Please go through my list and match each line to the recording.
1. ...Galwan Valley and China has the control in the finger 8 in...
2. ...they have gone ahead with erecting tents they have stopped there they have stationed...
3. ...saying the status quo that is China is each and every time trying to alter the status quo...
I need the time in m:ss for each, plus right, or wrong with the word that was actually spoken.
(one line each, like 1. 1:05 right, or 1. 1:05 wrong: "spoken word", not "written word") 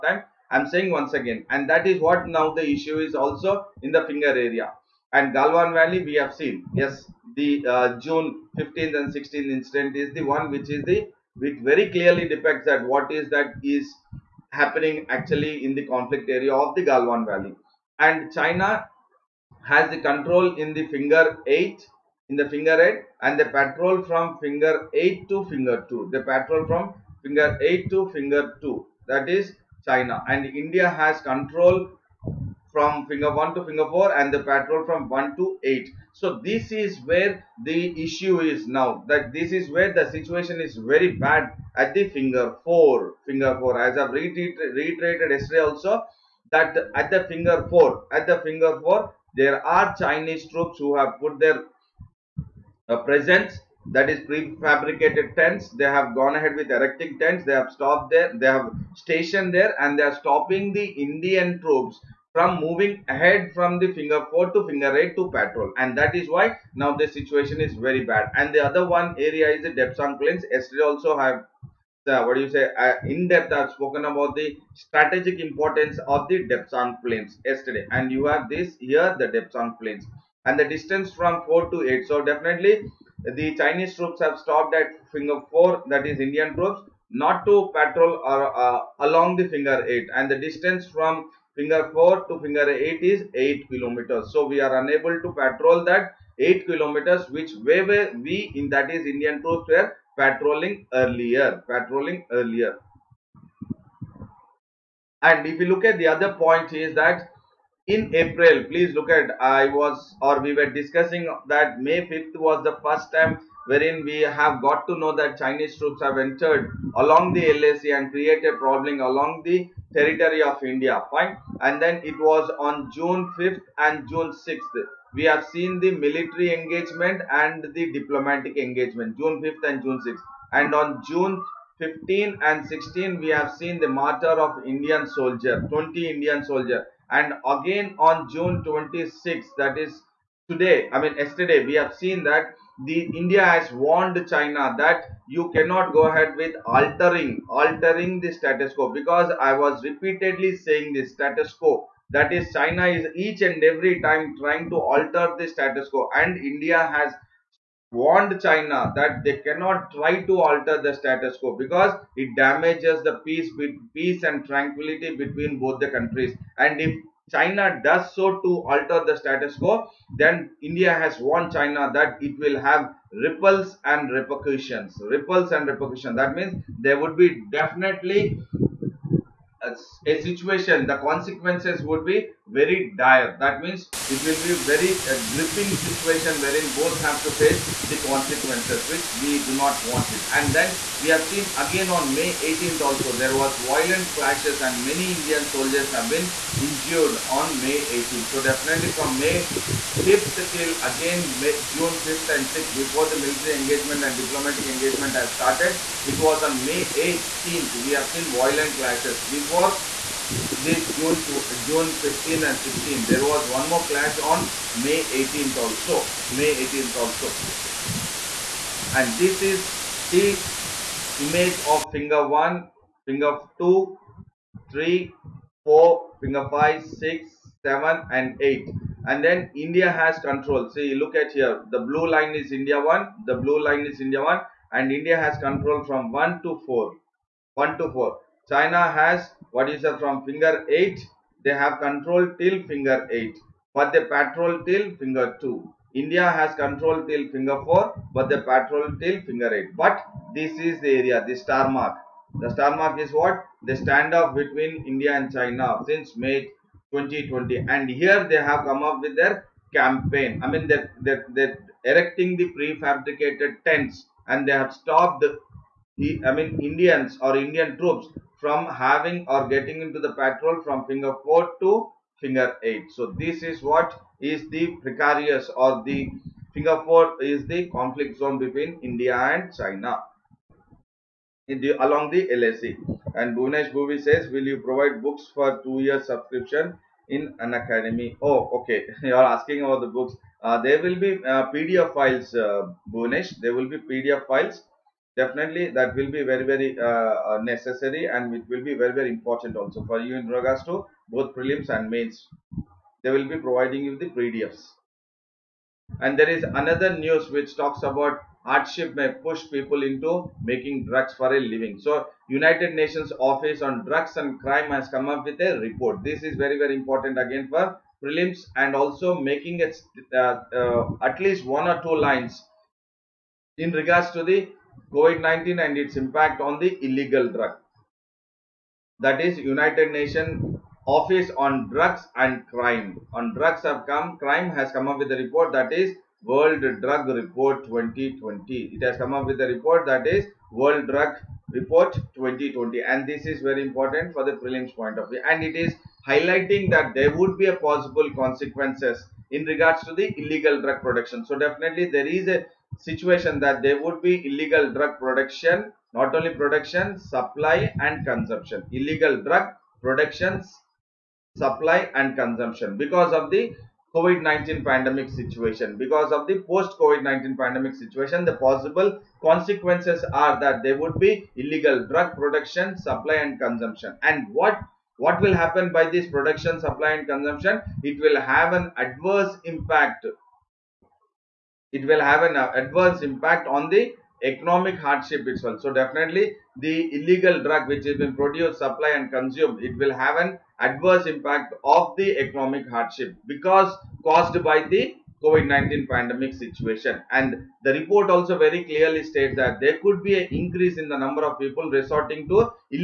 1. 0:16 right
2. 0:55 right
3. 2:30 right.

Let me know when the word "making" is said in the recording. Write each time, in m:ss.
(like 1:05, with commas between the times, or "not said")
5:10, 5:19.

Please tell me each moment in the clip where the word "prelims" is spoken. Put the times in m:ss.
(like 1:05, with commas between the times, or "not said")
5:01, 5:18, 5:44.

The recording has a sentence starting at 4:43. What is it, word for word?
And Bhunesh Bhuvi says, will you provide books for two year subscription in Unacademy?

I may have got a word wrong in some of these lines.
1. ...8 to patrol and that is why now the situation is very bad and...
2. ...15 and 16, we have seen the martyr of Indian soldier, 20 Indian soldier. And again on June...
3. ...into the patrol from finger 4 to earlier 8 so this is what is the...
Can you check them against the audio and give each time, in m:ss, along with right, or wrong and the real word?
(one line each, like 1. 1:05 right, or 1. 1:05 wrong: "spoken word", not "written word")
1. 1:04 right
2. 2:11 right
3. 4:29 wrong: "finger", not "earlier".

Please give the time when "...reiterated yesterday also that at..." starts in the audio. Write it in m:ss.
0:44.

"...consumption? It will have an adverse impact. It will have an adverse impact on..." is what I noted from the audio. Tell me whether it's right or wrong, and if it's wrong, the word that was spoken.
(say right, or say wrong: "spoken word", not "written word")
right.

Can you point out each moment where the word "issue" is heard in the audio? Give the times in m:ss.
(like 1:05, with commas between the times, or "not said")
0:02, 0:38.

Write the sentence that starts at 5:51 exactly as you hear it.
So definitely there is a situation that there would be illegal drug production, not only production, supply and consumption.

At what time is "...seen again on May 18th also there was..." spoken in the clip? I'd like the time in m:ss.
3:11.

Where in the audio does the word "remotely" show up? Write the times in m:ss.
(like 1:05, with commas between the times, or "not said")
not said.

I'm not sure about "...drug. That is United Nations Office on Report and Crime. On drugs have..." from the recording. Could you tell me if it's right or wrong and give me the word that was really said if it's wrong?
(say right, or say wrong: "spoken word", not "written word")
wrong: "Drugs", not "Report".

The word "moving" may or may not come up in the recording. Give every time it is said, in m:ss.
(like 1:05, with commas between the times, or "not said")
1:02.